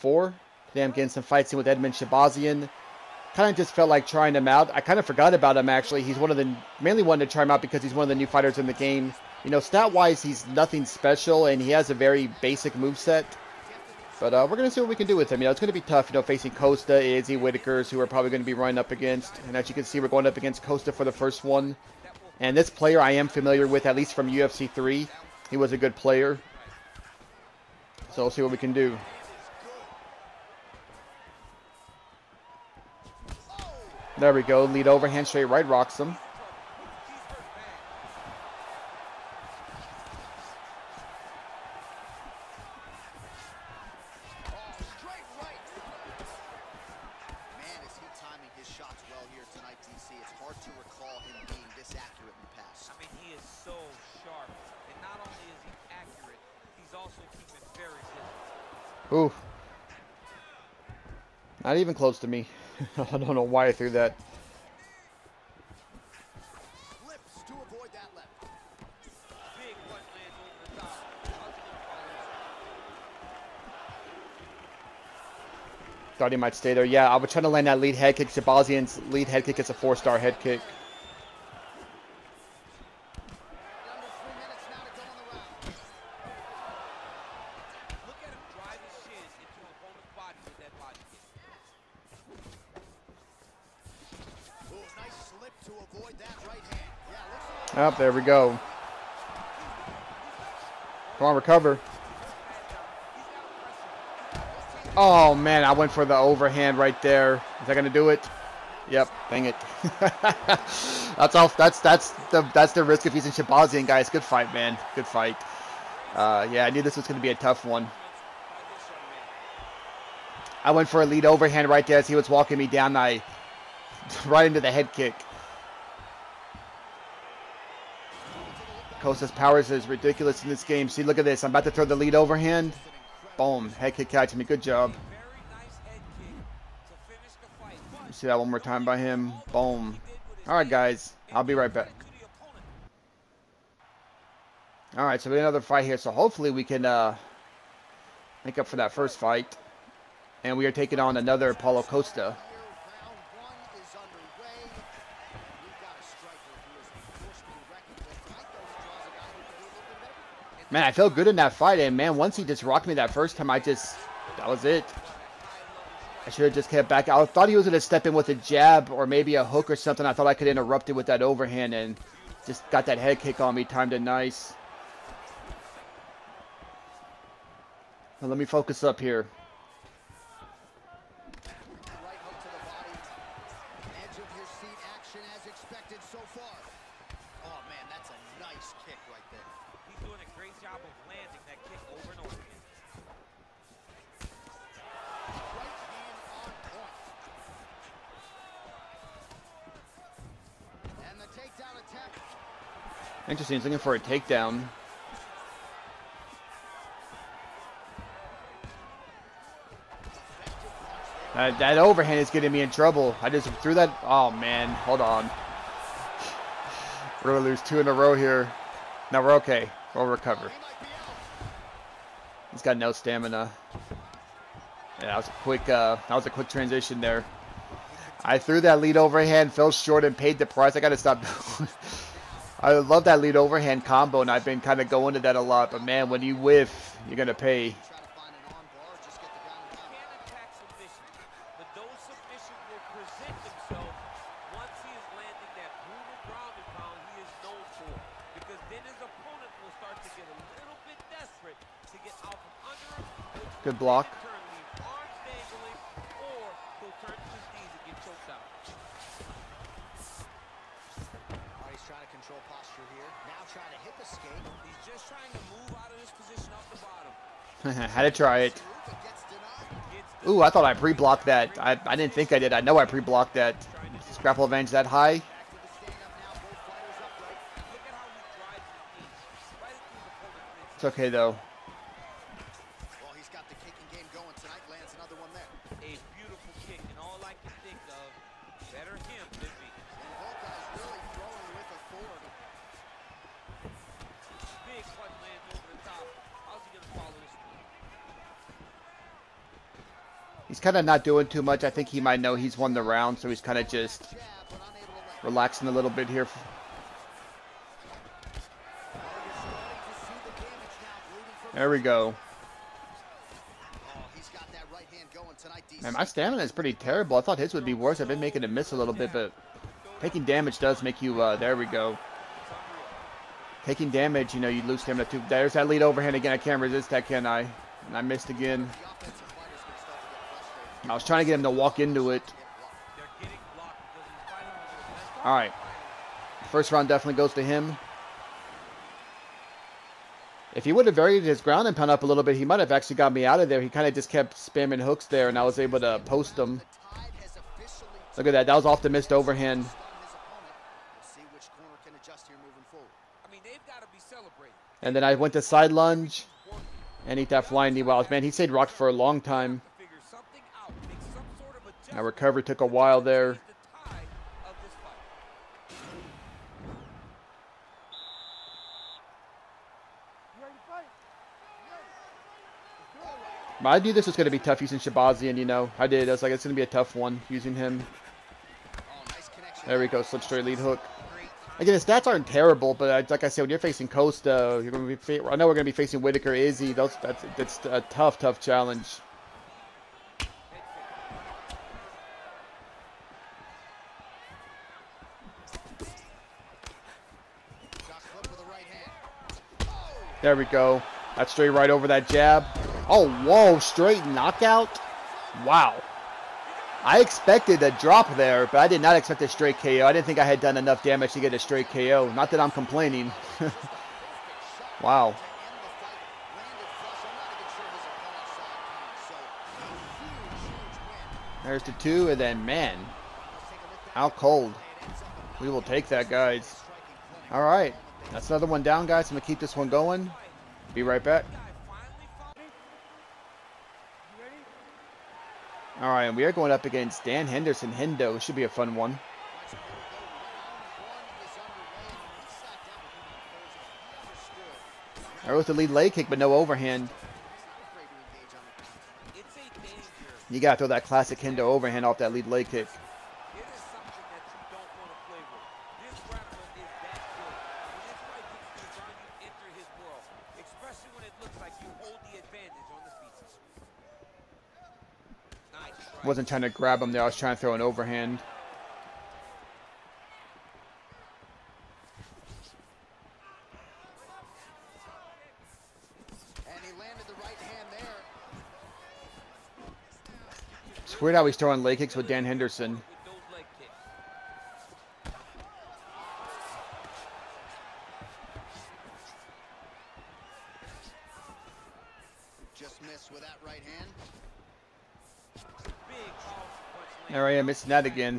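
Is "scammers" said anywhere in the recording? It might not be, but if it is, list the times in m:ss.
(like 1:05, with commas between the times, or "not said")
not said.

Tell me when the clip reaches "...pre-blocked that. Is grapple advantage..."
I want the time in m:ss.
4:32.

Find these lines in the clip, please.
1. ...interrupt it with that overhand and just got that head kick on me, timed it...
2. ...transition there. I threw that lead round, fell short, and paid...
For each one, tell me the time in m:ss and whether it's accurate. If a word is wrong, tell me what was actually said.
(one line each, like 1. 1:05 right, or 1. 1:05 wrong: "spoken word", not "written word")
1. 2:50 right
2. 3:46 wrong: "overhand", not "round".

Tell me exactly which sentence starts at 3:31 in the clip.
Uh, that overhand is getting me in trouble.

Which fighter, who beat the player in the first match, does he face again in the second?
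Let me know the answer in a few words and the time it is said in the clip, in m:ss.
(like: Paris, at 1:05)
Paulo Costa, at 2:31.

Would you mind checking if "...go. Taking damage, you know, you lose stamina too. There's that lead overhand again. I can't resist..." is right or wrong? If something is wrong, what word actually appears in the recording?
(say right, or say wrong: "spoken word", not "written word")
right.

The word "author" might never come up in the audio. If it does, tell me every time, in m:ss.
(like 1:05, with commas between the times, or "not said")
not said.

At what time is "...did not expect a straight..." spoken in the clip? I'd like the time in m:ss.
6:48.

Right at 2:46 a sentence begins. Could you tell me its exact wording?
I should have just kept back.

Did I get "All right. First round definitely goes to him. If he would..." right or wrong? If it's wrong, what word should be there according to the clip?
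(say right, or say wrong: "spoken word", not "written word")
right.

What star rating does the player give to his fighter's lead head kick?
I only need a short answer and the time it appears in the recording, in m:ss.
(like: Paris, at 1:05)
four-star, at 1:19.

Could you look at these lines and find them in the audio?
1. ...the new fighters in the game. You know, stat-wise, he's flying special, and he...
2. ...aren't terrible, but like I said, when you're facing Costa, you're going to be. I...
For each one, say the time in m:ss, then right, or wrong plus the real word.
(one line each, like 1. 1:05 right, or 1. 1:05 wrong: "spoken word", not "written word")
1. 0:08 wrong: "nothing", not "flying"
2. 6:22 right.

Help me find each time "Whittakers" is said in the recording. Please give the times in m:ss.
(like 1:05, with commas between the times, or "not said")
0:17, 6:26.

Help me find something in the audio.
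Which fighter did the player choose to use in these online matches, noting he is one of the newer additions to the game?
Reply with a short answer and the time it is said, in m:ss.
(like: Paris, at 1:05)
Edmen Shahbazyan, at 0:01.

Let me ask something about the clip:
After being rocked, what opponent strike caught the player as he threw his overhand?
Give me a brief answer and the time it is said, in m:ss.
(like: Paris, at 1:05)
flying knee, at 5:57.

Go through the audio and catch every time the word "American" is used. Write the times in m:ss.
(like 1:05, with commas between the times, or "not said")
not said.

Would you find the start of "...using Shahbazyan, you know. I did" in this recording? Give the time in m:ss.
6:14.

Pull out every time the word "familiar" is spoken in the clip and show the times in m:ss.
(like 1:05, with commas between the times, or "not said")
0:23.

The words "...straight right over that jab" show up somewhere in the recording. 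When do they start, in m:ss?
6:41.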